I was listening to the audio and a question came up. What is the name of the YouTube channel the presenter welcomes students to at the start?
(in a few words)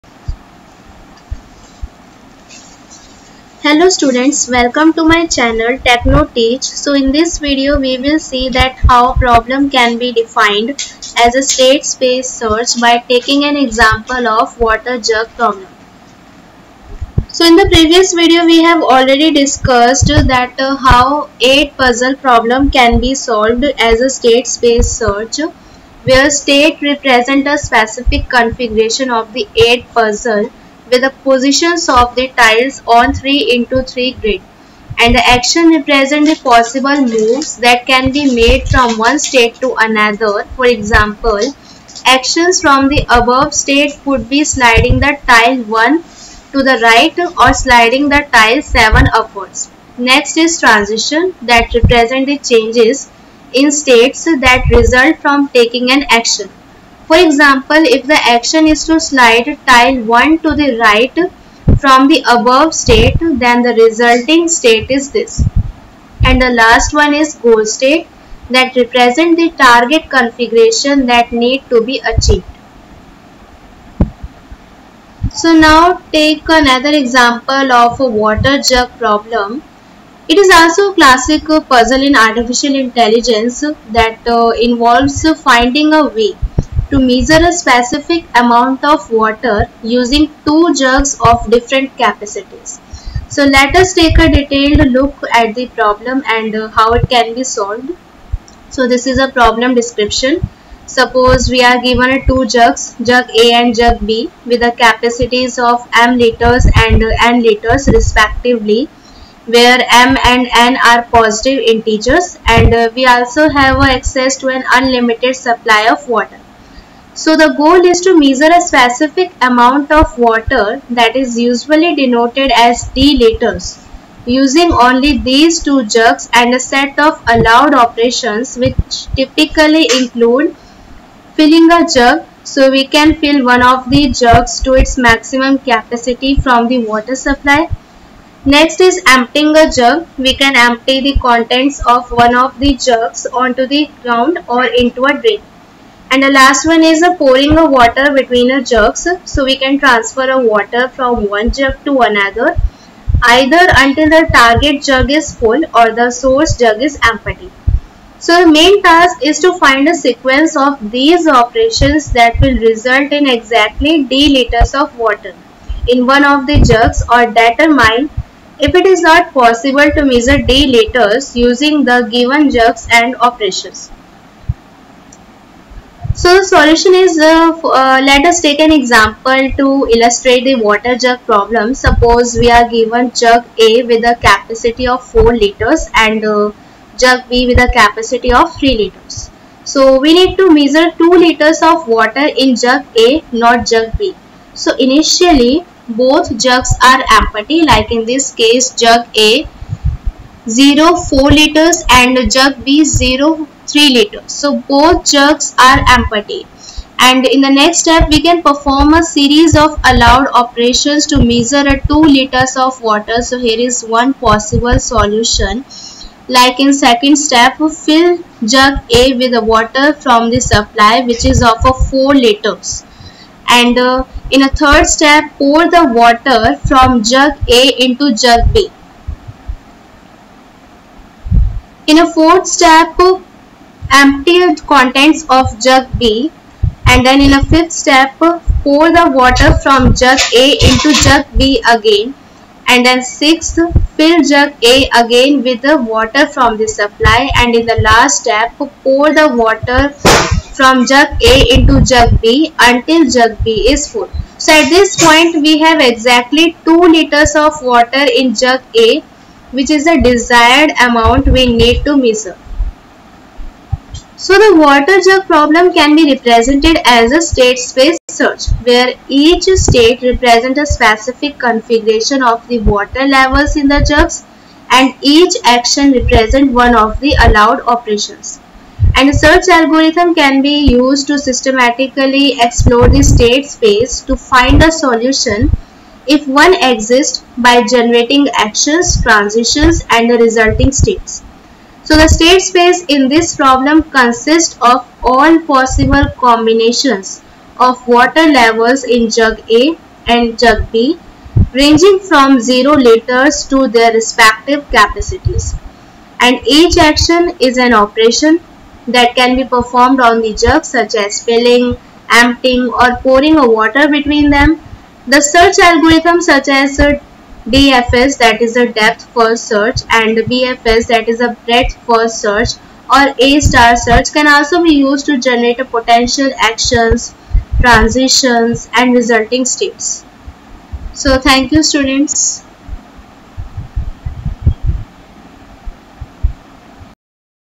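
Techno Teach.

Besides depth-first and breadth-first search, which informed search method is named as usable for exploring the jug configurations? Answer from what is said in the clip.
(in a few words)
A star search.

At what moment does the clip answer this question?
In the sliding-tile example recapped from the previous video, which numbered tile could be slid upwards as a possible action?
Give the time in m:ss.
0:48.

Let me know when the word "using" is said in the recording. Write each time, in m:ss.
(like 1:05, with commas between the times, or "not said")
1:29, 2:04, 2:51.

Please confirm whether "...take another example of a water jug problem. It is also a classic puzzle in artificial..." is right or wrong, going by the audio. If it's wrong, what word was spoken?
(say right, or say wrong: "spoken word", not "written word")
right.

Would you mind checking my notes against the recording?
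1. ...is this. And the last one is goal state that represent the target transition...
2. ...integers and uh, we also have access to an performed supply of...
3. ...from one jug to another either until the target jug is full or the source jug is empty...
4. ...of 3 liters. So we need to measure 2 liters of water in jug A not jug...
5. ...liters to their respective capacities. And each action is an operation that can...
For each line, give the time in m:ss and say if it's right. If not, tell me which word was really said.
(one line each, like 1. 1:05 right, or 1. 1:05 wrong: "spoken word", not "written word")
1. 1:04 wrong: "configuration", not "transition"
2. 1:51 wrong: "unlimited", not "performed"
3. 2:30 right
4. 3:08 right
5. 5:02 right.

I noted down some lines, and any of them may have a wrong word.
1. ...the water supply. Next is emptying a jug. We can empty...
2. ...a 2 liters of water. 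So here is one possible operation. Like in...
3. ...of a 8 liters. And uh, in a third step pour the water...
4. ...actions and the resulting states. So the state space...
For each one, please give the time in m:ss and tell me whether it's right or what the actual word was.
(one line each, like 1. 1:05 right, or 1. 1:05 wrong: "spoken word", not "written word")
1. 2:16 right
2. 3:31 wrong: "solution", not "operation"
3. 3:41 wrong: "4", not "8"
4. 4:49 wrong: "transitions", not "actions".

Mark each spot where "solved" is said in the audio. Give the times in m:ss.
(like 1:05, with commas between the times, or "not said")
0:23, 1:37.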